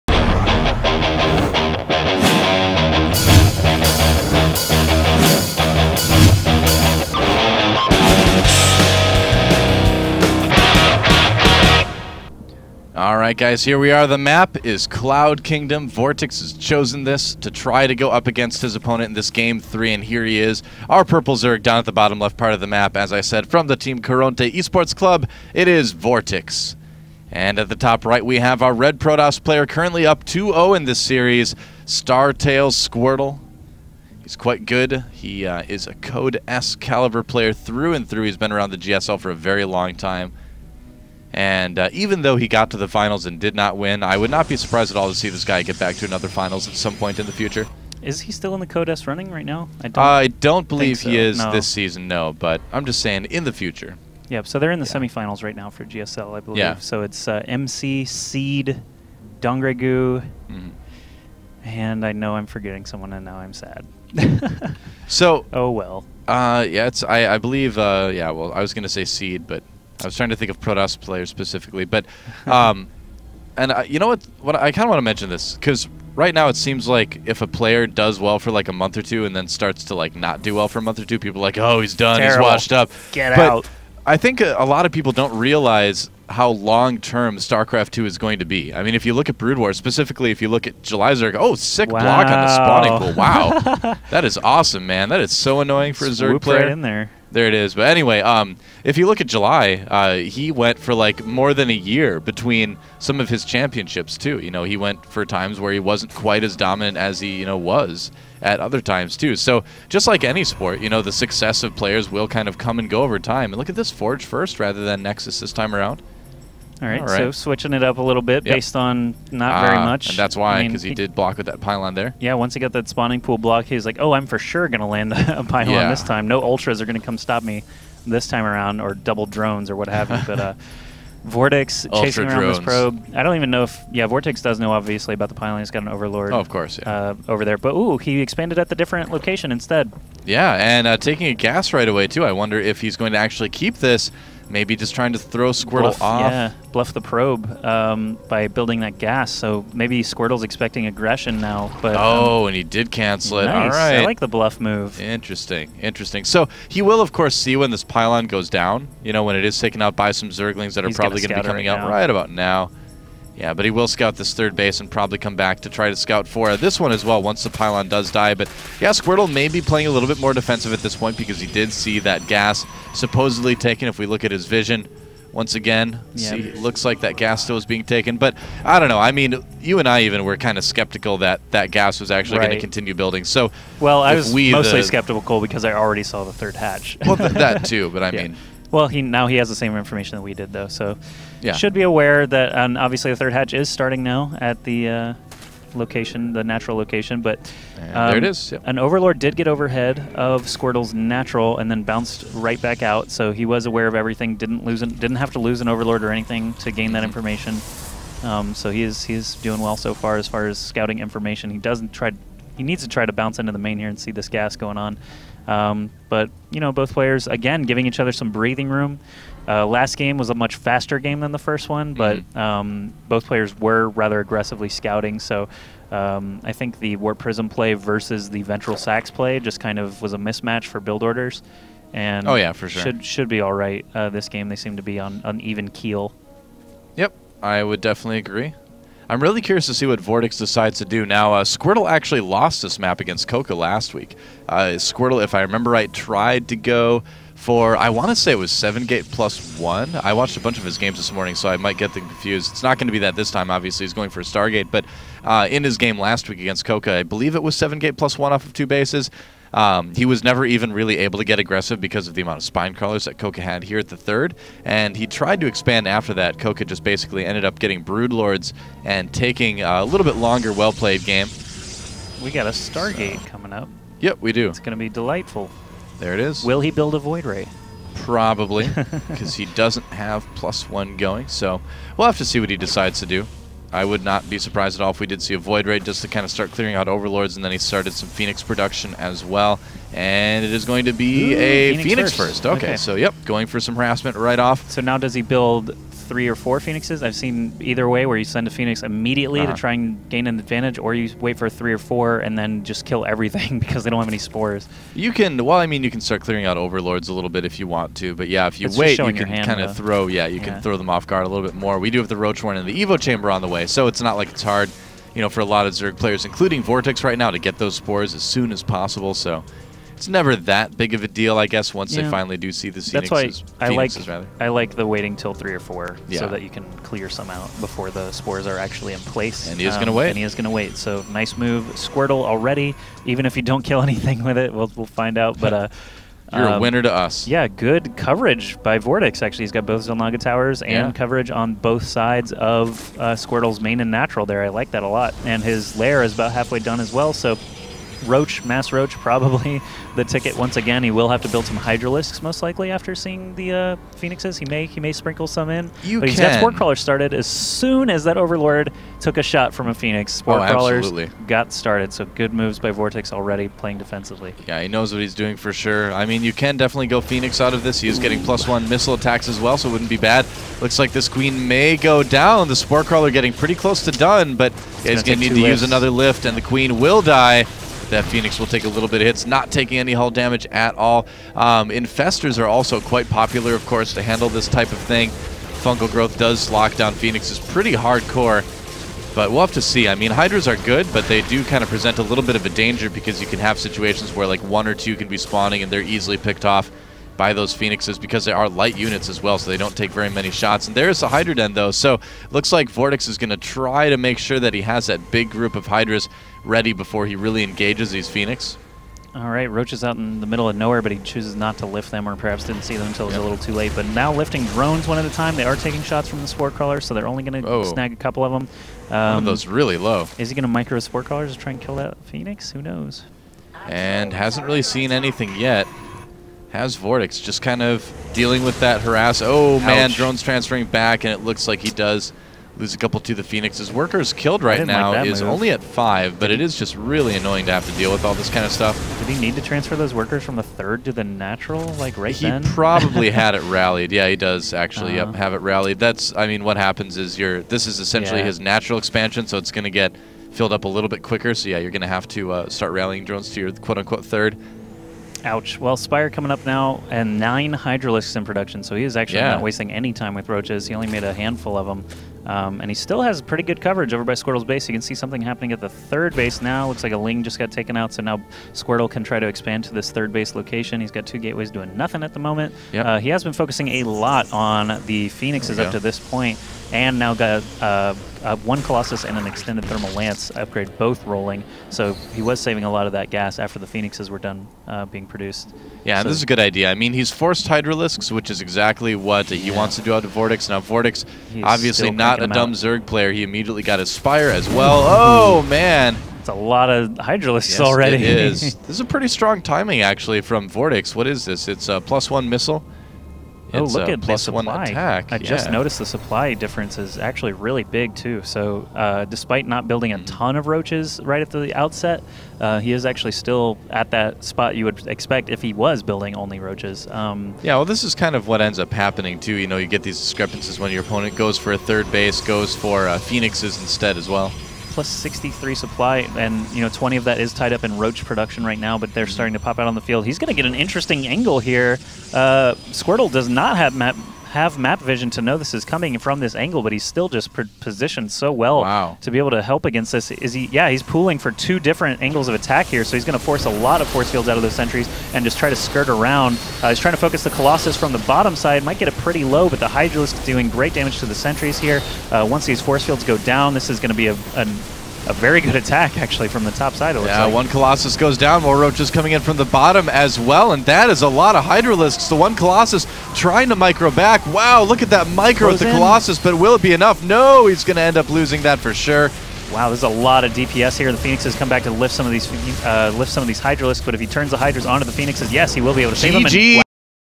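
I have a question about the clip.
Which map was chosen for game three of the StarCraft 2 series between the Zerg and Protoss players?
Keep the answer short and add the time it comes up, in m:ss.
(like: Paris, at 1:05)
Cloud Kingdom, at 0:14.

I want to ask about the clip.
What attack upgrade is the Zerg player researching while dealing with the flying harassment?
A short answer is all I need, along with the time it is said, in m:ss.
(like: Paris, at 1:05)
plus one missile attacks, at 6:08.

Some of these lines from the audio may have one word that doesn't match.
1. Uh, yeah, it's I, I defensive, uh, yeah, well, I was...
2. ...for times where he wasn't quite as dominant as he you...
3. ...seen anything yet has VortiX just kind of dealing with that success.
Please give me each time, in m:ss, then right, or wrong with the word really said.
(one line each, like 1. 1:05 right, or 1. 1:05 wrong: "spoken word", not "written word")
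1. 1:06 wrong: "believe", not "defensive"
2. 1:45 right
3. 7:04 wrong: "harass", not "success".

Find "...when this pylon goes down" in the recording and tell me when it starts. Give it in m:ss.
2:37.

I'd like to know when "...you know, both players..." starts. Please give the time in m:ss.
3:36.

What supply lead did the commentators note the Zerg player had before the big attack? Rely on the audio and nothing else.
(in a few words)
63.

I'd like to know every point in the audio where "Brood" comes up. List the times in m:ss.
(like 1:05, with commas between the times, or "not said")
1:29, 4:27.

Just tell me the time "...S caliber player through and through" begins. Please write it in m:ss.
0:36.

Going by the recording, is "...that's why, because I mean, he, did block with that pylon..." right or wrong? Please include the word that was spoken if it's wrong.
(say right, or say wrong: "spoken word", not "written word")
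right.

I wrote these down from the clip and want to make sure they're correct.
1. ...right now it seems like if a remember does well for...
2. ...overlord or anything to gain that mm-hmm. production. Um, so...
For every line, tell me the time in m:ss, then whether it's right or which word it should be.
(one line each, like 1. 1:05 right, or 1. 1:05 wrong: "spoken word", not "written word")
1. 1:16 wrong: "player", not "remember"
2. 3:25 wrong: "information", not "production".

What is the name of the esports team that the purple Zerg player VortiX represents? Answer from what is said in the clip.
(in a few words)
Coronte Esports Club.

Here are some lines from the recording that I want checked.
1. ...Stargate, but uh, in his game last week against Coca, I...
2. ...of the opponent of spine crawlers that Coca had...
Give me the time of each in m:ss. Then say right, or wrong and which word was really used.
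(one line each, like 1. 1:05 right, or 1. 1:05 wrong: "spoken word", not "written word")
1. 4:14 right
2. 4:22 wrong: "amount", not "opponent".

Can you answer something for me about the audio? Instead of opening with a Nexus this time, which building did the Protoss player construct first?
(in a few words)
Forge.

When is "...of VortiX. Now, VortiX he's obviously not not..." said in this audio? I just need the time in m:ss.
8:10.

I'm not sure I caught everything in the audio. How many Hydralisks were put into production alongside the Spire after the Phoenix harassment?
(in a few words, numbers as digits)
9.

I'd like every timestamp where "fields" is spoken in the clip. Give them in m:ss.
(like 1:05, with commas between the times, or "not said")
8:49, 9:04, 9:12.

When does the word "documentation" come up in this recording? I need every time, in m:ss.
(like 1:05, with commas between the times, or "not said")
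not said.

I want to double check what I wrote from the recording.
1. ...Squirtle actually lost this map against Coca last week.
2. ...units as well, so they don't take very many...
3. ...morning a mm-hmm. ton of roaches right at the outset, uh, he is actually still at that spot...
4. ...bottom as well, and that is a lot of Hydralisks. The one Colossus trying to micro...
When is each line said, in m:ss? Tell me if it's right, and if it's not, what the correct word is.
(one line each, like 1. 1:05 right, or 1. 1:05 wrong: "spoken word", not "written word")
1. 4:01 right
2. 6:38 right
3. 8:29 wrong: "building", not "morning"
4. 9:19 right.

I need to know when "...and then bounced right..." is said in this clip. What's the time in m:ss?
3:21.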